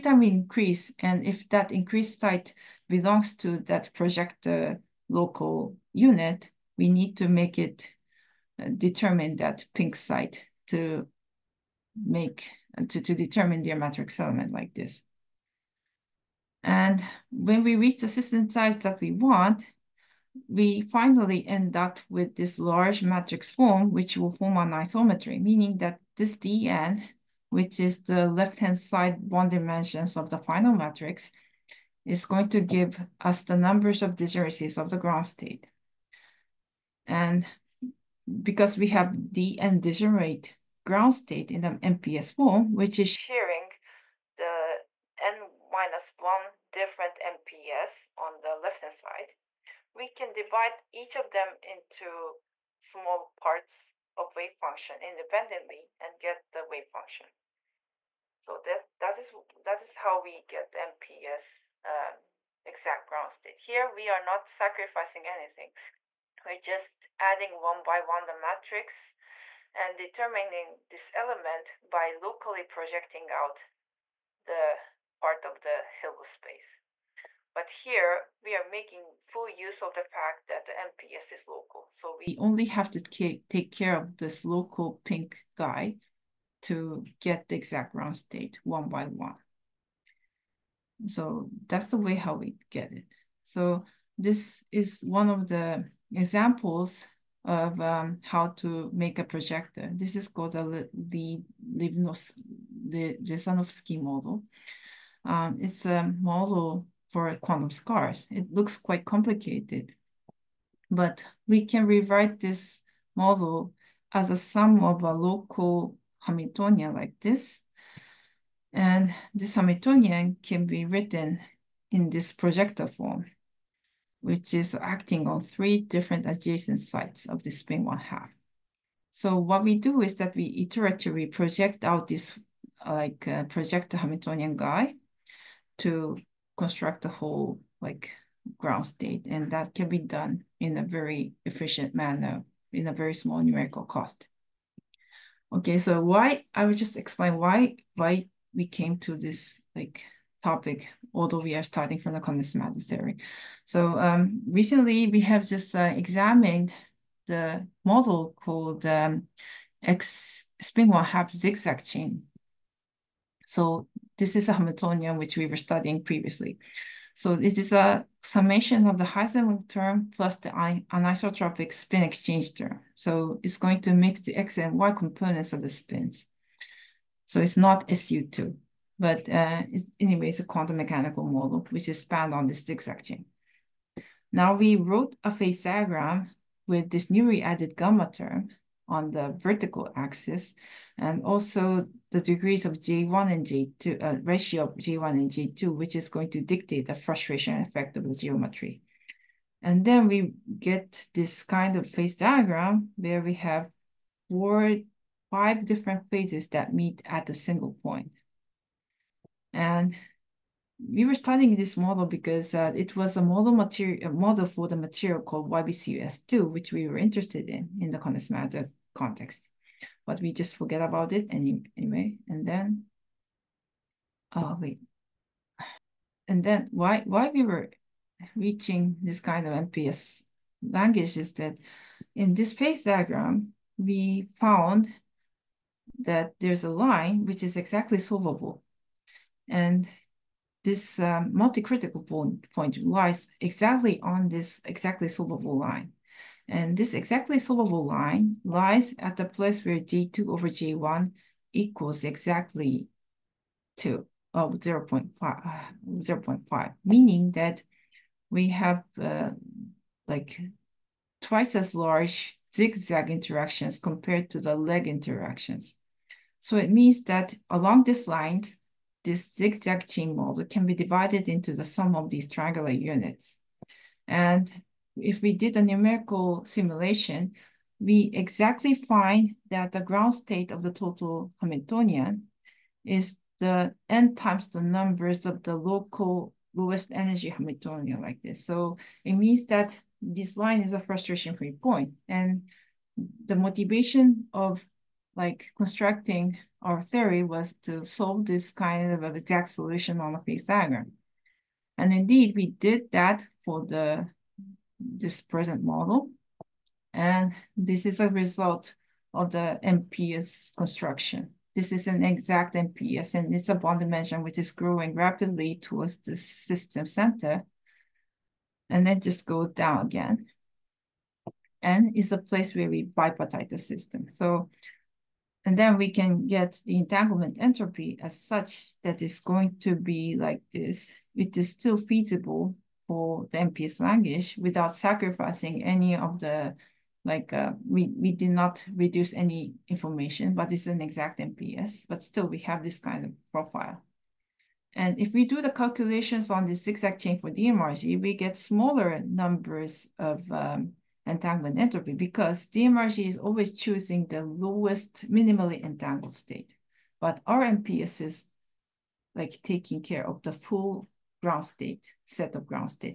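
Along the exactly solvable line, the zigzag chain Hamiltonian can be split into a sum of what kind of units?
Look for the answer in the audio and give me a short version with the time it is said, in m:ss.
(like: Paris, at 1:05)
triangular units, at 4:32.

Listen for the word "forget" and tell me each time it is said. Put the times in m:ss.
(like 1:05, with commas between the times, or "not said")
3:40.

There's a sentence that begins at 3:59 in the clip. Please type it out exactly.
And this um, multi-critical point, point lies exactly on this exactly solvable line.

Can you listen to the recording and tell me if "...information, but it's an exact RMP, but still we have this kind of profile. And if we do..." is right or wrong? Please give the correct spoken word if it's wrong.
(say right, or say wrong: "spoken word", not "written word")
wrong: "MPS", not "RMP".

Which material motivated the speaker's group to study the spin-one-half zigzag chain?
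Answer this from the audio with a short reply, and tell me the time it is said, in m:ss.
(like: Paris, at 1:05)
YBCuS2, at 3:35.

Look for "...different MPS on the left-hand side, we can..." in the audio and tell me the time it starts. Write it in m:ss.
0:46.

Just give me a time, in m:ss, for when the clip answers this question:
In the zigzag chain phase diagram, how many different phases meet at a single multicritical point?
3:25.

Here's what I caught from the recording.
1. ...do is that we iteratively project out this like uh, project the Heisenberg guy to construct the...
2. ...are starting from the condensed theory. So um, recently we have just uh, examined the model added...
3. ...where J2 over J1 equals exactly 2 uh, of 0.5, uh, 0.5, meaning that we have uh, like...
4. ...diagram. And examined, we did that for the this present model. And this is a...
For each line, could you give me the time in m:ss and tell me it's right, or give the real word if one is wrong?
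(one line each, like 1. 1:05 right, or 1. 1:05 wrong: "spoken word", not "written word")
1. 2:09 wrong: "Hamiltonian", not "Heisenberg"
2. 2:31 wrong: "called", not "added"
3. 4:09 right
4. 5:00 wrong: "indeed", not "examined".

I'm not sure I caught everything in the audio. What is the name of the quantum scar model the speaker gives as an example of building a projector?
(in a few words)
Lesanovsky model.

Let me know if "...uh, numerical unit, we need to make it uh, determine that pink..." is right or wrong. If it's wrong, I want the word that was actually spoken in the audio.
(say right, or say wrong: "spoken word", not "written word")
wrong: "local", not "numerical".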